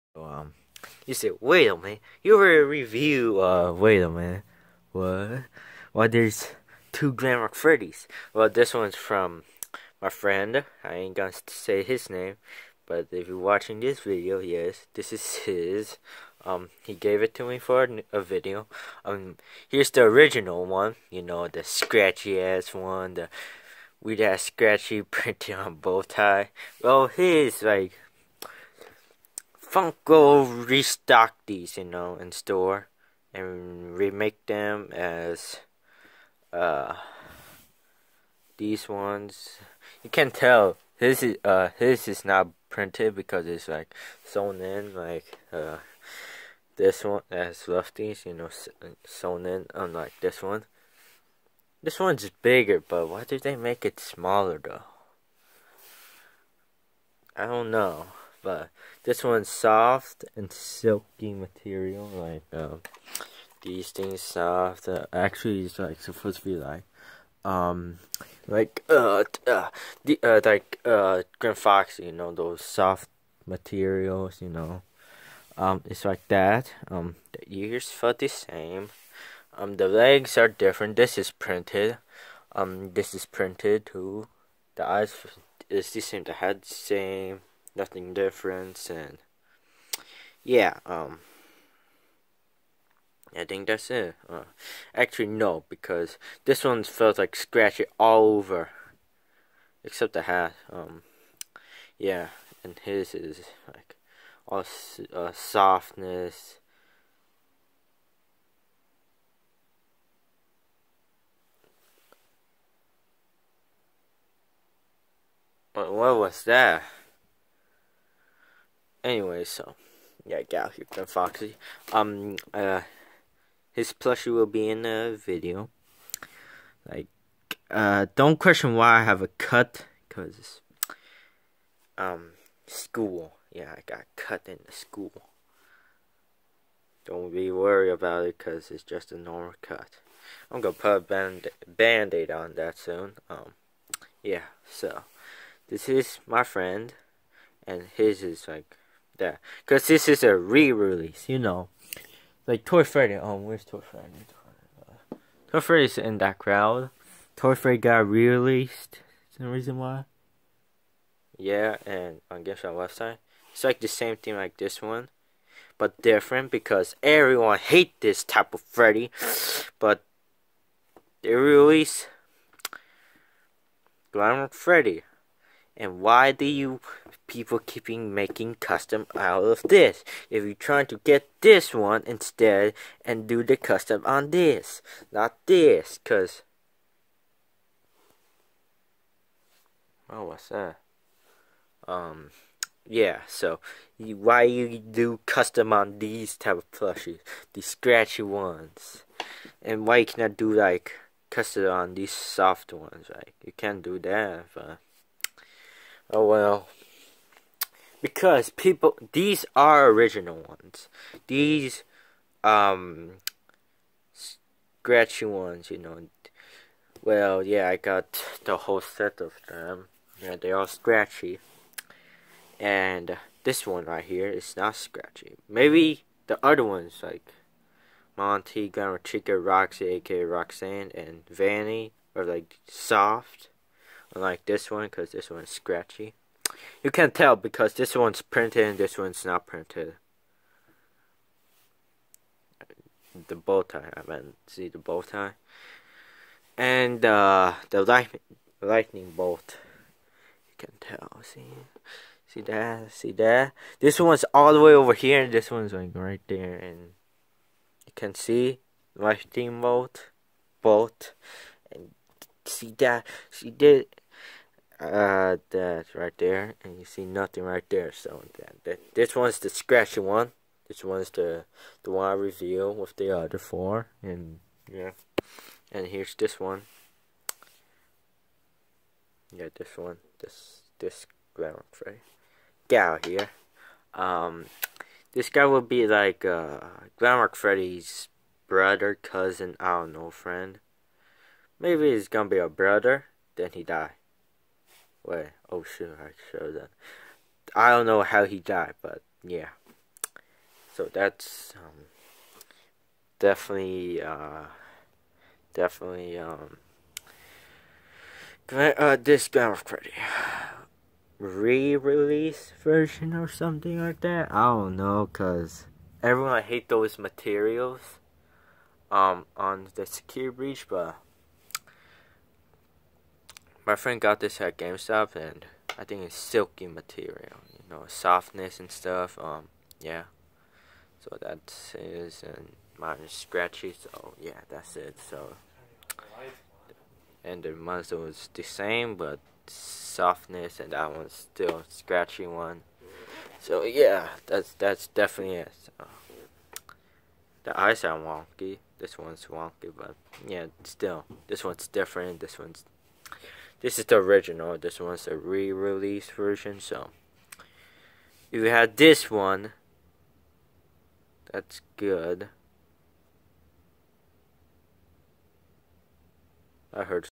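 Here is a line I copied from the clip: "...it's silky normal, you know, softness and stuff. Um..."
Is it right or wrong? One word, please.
wrong.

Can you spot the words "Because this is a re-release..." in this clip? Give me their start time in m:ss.
2:29.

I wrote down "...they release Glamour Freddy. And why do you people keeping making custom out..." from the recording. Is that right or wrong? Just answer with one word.
right.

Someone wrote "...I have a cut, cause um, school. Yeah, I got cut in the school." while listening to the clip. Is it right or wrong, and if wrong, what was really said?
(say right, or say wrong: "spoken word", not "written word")
right.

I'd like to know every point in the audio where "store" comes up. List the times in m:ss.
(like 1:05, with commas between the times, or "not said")
0:32.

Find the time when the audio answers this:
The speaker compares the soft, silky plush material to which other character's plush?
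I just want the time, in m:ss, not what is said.
1:11.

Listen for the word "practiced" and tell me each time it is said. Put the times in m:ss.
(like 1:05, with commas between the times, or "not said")
not said.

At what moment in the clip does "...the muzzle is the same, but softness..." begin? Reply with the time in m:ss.
5:37.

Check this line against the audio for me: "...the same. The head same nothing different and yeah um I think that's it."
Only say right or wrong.
right.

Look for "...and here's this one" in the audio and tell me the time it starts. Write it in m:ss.
4:35.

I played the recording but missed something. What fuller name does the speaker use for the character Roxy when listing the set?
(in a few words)
Roxanne.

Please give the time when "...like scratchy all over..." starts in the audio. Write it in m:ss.
1:37.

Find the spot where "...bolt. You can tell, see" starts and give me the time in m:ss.
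4:09.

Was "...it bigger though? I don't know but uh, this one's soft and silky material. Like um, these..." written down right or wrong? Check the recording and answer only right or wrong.
wrong.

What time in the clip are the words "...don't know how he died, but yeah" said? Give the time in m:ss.
4:57.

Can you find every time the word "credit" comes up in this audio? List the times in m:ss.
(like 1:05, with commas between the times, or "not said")
5:09.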